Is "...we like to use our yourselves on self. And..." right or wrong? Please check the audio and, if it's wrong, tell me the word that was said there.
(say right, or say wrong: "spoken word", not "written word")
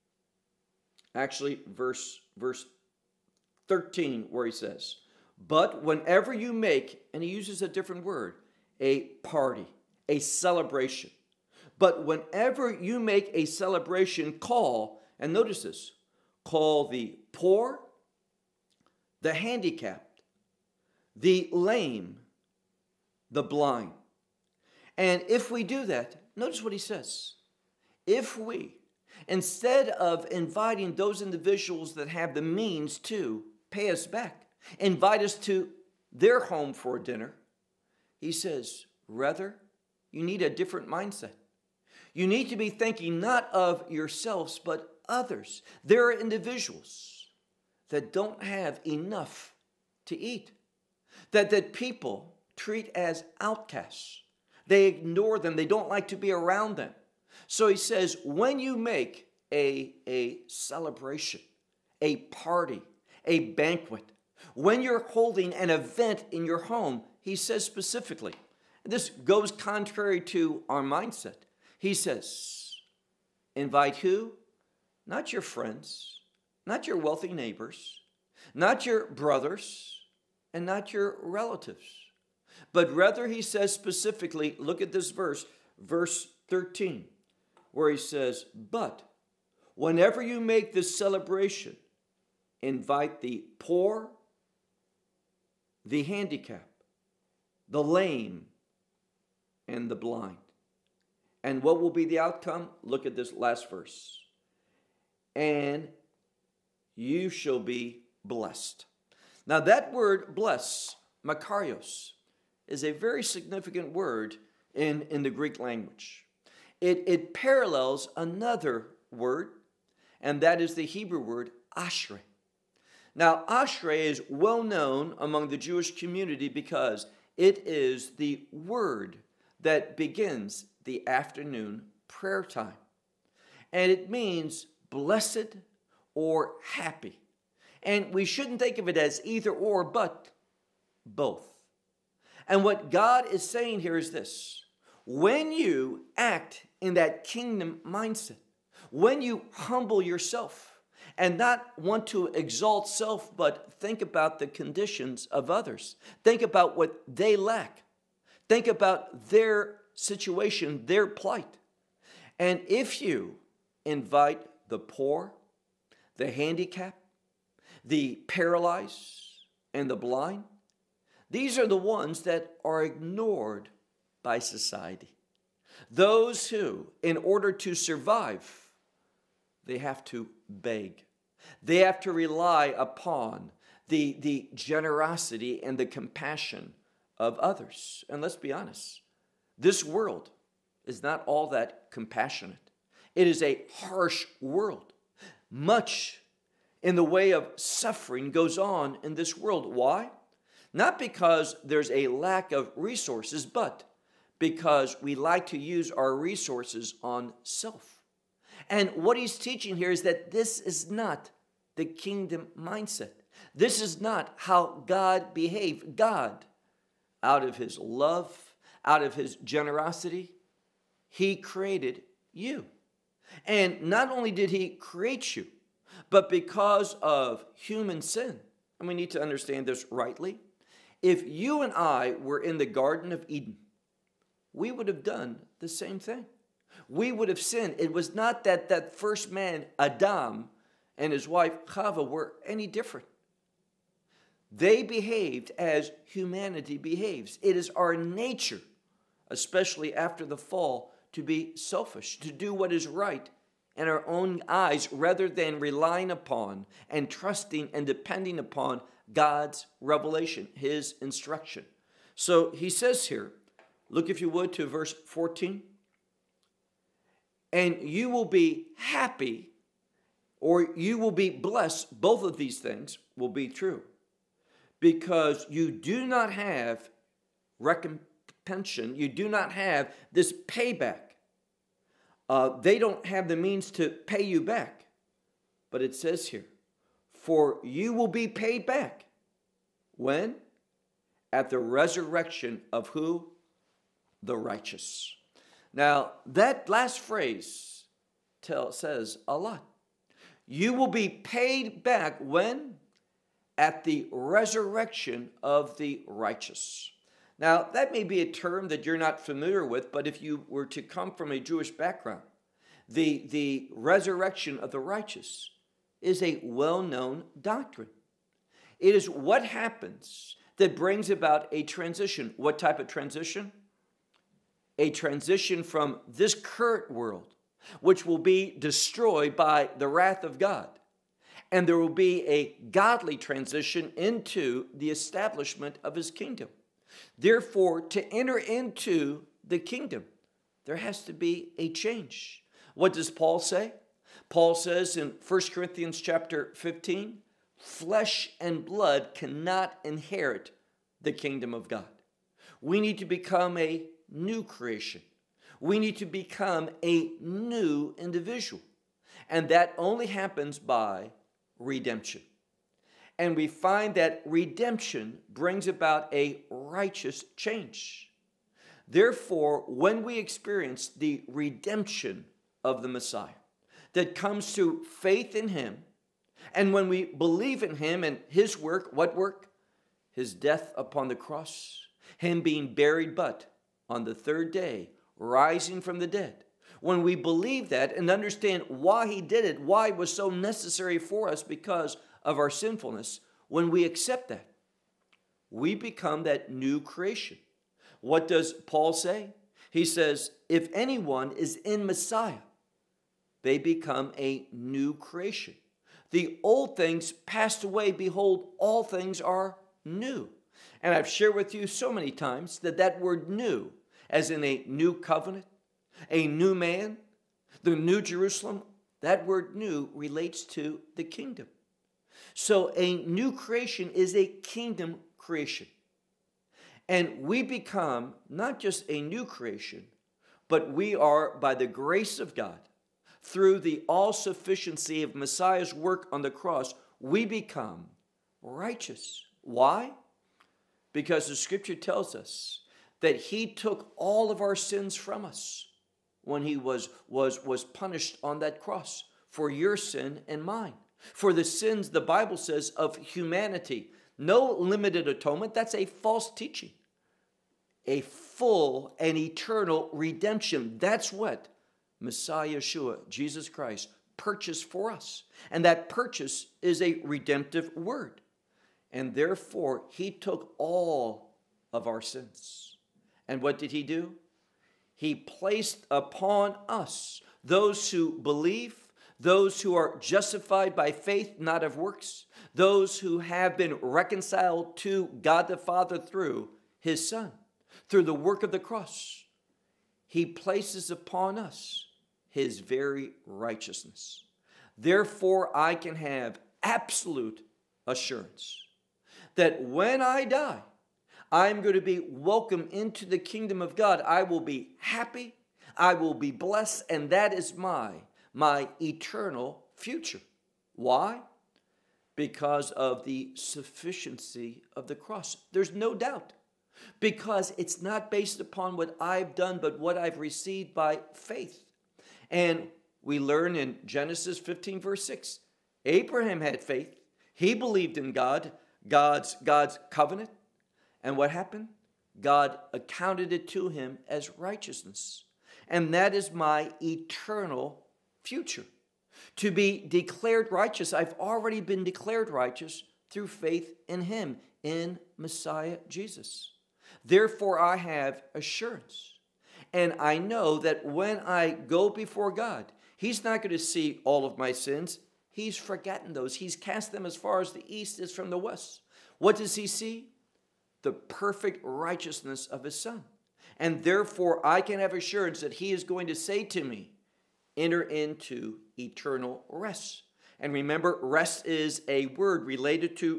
wrong: "resources", not "yourselves".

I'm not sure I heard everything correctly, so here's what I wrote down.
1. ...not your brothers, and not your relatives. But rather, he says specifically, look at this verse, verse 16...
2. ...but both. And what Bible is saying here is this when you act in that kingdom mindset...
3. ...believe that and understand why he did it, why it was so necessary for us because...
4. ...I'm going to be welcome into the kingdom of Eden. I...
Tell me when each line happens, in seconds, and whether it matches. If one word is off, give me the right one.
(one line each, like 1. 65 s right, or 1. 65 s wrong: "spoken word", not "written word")
1. 78 s wrong: "13", not "16"
2. 139 s wrong: "God", not "Bible"
3. 387 s right
4. 501 s wrong: "God", not "Eden".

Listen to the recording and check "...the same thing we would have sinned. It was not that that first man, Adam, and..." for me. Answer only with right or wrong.
right.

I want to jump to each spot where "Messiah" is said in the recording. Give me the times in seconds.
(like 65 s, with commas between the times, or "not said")
372 s, 401 s, 435 s, 462 s, 545 s.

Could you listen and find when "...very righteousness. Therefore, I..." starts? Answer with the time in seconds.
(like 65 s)
492 s.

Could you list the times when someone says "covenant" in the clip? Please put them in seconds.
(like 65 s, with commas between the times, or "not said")
414 s, 529 s.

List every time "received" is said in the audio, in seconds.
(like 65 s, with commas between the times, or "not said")
520 s.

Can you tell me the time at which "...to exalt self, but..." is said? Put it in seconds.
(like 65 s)
152 s.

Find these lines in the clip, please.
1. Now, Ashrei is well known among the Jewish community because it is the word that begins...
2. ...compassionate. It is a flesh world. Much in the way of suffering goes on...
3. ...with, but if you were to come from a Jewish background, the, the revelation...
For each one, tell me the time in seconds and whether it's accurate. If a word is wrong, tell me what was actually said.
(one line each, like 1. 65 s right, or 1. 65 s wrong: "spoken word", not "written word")
1. 123 s right
2. 191 s wrong: "harsh", not "flesh"
3. 309 s wrong: "resurrection", not "revelation".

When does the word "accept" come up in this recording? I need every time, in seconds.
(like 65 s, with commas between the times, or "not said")
393 s.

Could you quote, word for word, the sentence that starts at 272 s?
Both of these things will be true because you do not have recompense, you do not have this payback.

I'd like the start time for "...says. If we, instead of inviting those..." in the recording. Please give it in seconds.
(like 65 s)
26 s.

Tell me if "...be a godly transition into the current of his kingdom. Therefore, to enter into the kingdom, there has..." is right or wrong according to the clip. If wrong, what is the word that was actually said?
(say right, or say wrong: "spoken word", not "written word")
wrong: "establishment", not "current".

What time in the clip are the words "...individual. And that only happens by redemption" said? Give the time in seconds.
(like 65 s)
357 s.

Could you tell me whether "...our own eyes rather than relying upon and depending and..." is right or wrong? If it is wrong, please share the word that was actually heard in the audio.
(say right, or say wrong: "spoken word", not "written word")
wrong: "trusting", not "depending".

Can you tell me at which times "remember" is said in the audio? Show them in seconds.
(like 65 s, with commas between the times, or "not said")
570 s.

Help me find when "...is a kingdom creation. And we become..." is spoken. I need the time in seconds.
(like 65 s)
423 s.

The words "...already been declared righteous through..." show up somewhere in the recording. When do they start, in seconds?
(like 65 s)
541 s.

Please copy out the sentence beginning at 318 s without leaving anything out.
It is what happens that brings about a transition.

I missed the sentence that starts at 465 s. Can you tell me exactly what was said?
And that purchase is a redemptive word.